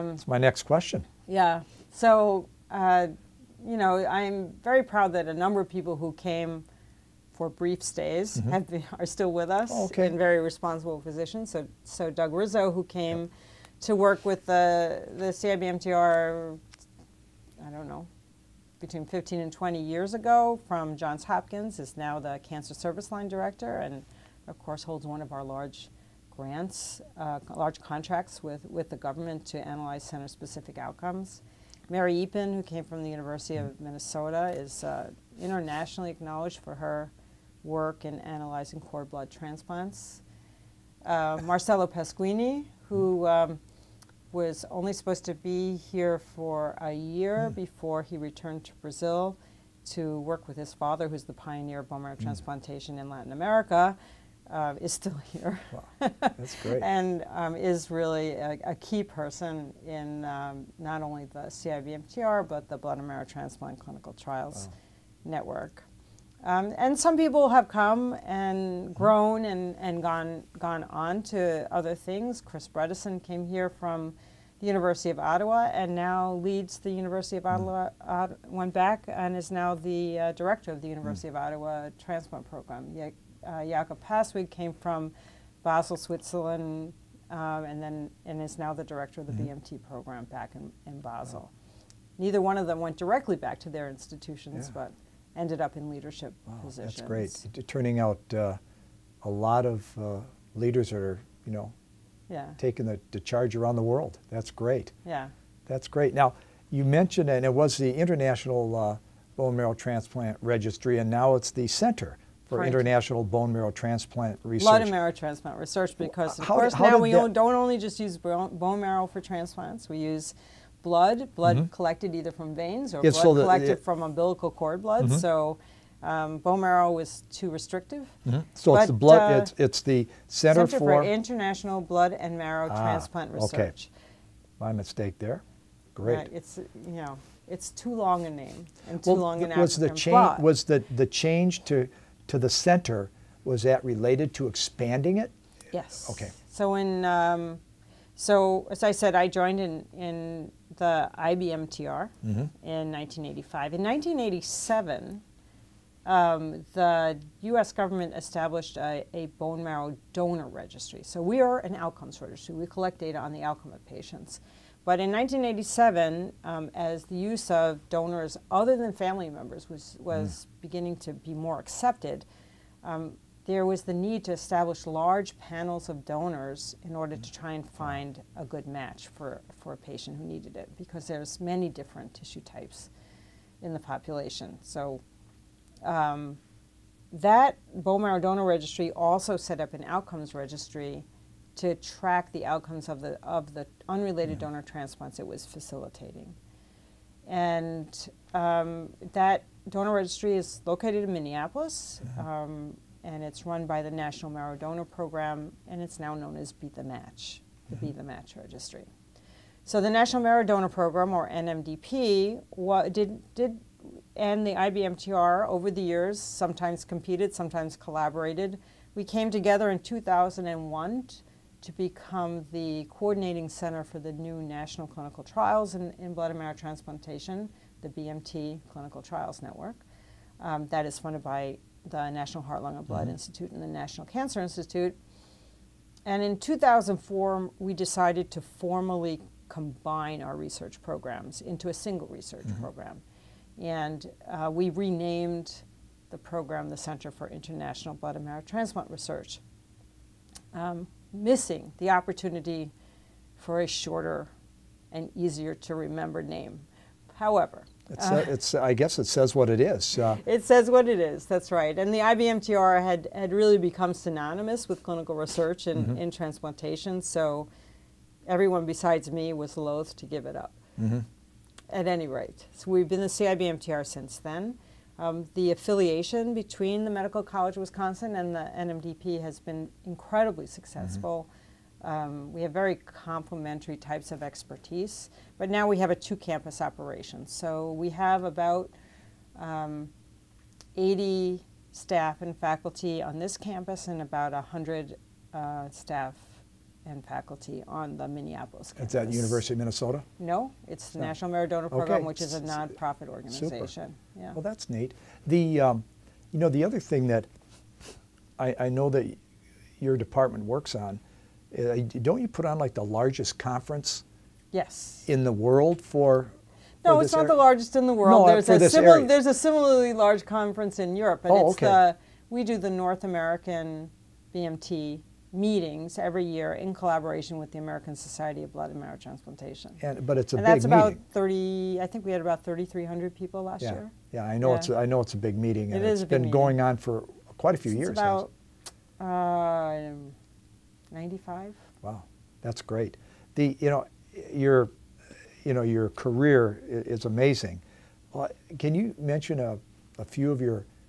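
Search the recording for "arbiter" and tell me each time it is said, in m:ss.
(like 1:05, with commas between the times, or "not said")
not said.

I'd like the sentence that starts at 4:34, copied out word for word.
Um, the affiliation between the Medical College of Wisconsin and the NMDP has been incredibly mm-hmm.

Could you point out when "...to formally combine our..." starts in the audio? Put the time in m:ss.
3:58.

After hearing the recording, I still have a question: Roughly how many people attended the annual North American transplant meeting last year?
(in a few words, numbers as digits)
3,300.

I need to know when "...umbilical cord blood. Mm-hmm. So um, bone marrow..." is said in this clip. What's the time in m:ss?
2:04.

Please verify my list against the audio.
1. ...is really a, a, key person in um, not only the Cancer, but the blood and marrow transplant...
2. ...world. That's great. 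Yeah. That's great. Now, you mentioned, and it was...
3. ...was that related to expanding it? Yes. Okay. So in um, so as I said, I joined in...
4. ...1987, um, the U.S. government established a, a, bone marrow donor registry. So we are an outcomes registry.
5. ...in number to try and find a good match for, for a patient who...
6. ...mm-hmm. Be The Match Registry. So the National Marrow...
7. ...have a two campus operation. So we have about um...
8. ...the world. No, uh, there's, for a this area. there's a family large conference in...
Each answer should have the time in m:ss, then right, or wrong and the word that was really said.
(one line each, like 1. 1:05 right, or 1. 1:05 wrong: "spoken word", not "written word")
1. 0:57 wrong: "CIBMTR", not "Cancer"
2. 1:43 right
3. 2:23 right
4. 2:33 right
5. 2:56 wrong: "order", not "number"
6. 3:27 right
7. 4:45 right
8. 5:17 wrong: "similarly", not "family".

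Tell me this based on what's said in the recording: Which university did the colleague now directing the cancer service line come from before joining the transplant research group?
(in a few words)
Johns Hopkins.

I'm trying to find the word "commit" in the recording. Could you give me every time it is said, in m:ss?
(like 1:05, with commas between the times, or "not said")
not said.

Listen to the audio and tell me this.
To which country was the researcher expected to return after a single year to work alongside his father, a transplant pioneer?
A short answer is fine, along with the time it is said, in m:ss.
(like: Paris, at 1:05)
Brazil, at 0:48.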